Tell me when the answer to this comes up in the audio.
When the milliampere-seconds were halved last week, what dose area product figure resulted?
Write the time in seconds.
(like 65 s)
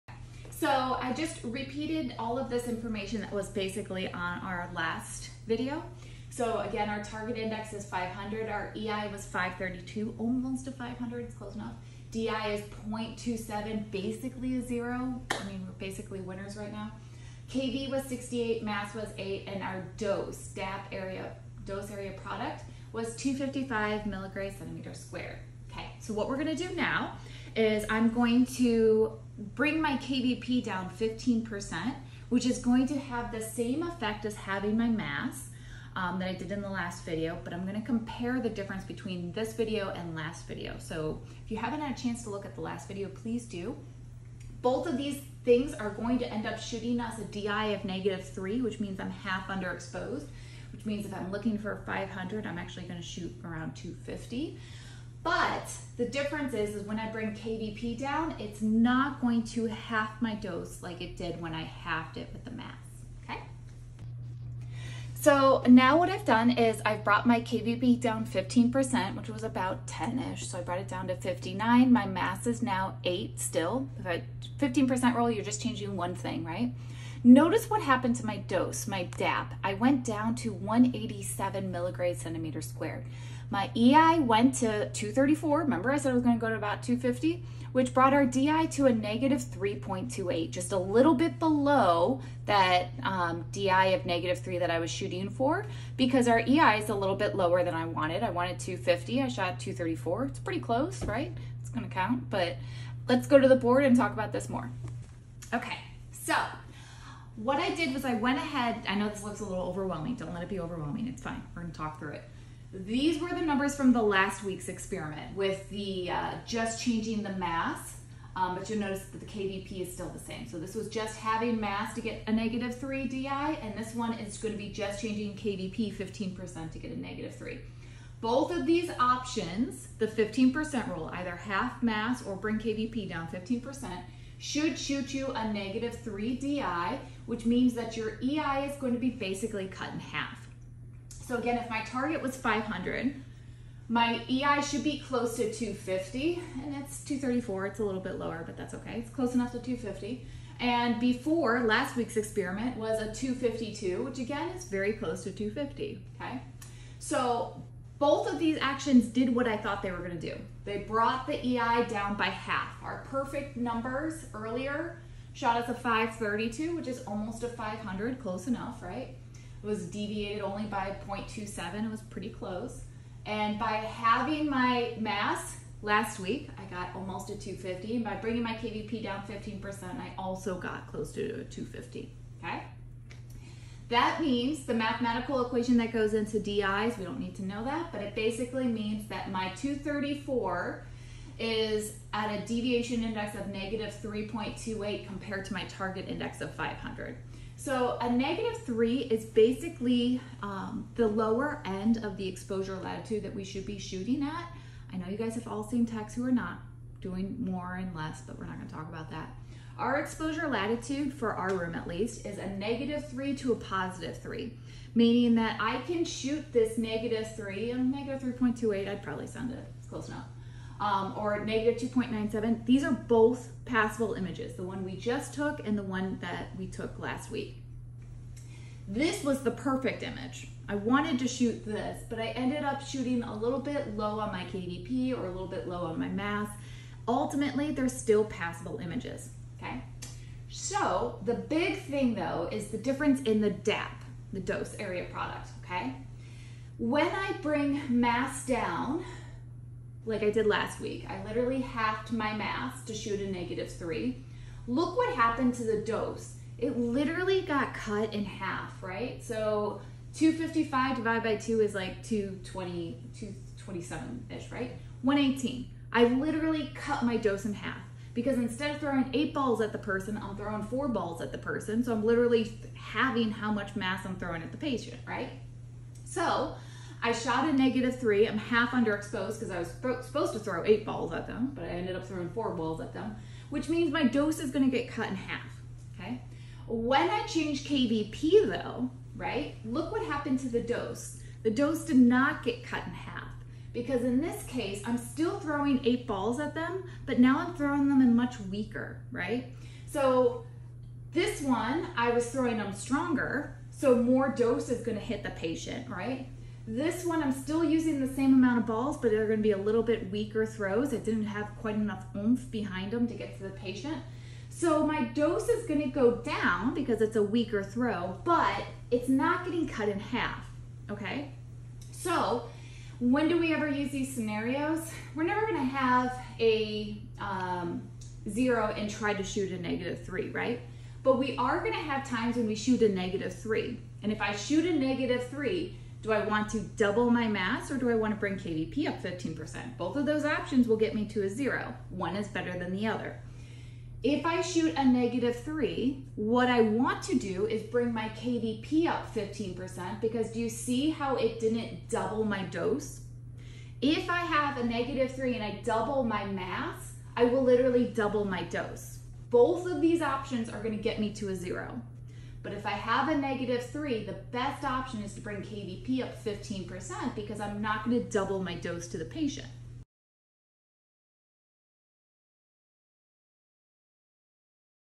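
265 s.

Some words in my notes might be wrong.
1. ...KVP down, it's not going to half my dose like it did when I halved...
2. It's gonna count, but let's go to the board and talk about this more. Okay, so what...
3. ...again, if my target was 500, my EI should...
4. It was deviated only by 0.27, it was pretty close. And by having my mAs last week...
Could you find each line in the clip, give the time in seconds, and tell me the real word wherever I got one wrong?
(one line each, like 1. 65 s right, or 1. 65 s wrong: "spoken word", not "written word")
1. 57 s right
2. 101 s right
3. 141 s right
4. 169 s right.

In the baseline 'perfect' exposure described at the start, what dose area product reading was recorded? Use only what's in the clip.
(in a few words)
255 milligrams centimeter squared.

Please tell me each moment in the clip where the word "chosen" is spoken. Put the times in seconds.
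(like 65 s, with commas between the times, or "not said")
not said.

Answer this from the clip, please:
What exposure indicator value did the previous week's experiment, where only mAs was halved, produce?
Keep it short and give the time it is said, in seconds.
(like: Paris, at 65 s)
252, at 153 s.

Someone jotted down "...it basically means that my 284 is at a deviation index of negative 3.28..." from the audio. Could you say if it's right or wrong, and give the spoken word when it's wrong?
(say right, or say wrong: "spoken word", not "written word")
wrong: "234", not "284".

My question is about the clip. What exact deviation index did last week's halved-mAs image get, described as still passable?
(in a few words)
-2.97.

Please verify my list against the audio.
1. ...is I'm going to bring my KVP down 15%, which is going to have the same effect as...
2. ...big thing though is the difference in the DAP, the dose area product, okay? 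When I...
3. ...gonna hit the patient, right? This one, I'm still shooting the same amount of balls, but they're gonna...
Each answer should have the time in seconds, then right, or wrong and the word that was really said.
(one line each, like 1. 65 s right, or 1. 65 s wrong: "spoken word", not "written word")
1. 27 s right
2. 241 s right
3. 304 s wrong: "using", not "shooting".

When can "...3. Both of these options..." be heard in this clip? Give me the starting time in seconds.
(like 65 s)
127 s.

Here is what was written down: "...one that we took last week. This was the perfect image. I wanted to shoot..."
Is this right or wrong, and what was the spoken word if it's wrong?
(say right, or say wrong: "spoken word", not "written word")
right.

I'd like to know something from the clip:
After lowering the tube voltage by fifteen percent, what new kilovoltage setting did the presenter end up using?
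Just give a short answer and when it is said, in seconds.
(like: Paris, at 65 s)
59, at 71 s.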